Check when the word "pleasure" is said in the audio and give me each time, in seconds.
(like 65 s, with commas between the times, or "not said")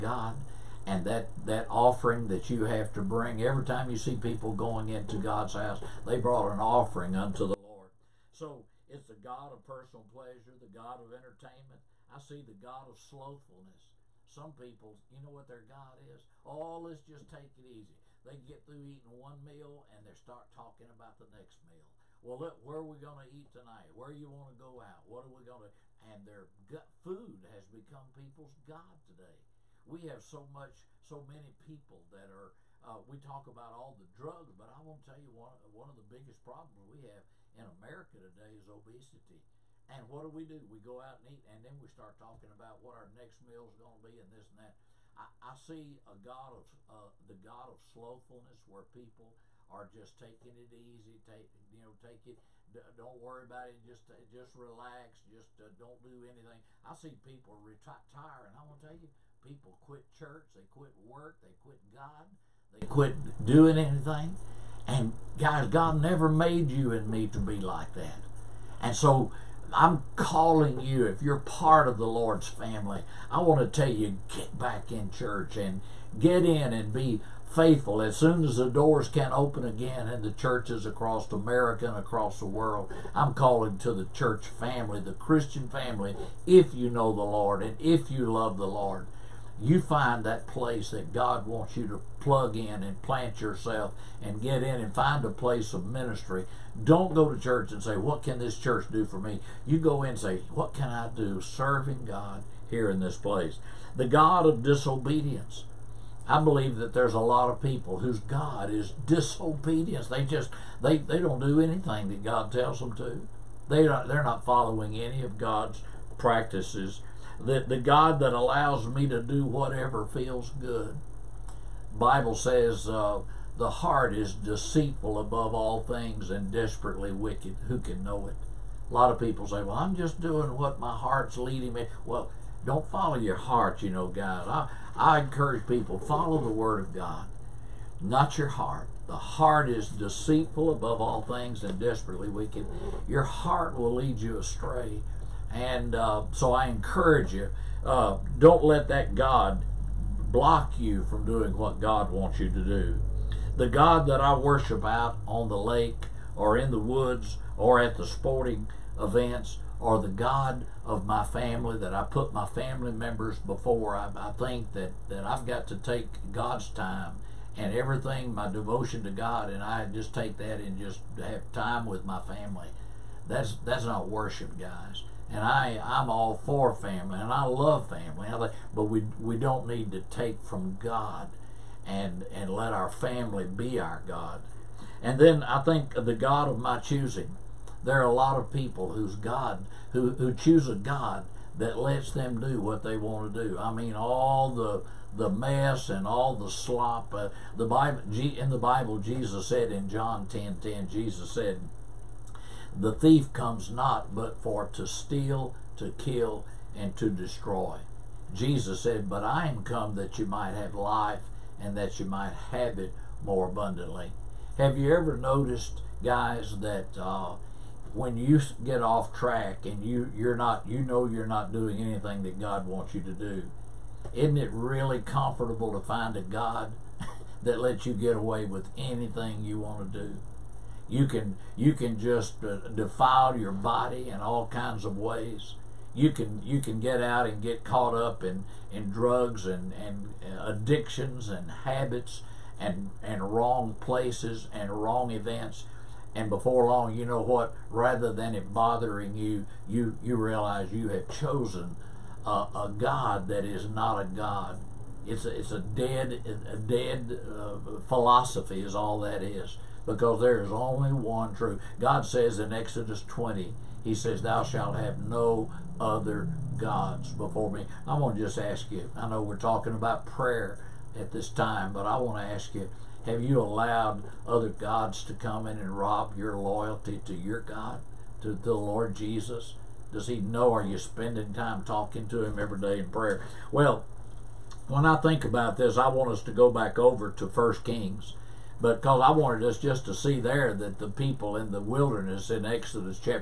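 10 s.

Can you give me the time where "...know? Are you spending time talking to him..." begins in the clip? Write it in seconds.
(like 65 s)
280 s.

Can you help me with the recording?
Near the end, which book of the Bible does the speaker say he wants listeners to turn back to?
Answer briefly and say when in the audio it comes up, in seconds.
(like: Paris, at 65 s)
1 Kings, at 287 s.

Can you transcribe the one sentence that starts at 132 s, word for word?
Well, don't follow your heart, you know, guys.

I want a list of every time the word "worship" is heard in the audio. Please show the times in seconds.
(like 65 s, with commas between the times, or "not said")
154 s, 174 s.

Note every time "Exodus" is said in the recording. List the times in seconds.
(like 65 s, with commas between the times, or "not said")
262 s, 292 s.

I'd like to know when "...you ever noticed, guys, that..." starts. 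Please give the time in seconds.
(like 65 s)
214 s.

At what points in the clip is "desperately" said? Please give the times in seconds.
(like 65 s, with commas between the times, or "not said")
126 s, 141 s.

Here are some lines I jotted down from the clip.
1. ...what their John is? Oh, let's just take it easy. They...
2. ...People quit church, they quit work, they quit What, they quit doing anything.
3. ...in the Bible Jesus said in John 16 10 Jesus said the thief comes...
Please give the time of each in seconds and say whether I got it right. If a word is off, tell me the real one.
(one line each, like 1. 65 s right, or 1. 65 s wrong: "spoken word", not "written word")
1. 15 s wrong: "God", not "John"
2. 59 s wrong: "God", not "What"
3. 198 s wrong: "10", not "16".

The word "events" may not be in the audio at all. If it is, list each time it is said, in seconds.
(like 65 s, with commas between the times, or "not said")
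158 s, 245 s.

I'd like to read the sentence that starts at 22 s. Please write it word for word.
Well, look, where are we going to eat tonight?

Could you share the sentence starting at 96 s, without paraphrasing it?
Don't go to church and say, What can this church do for me?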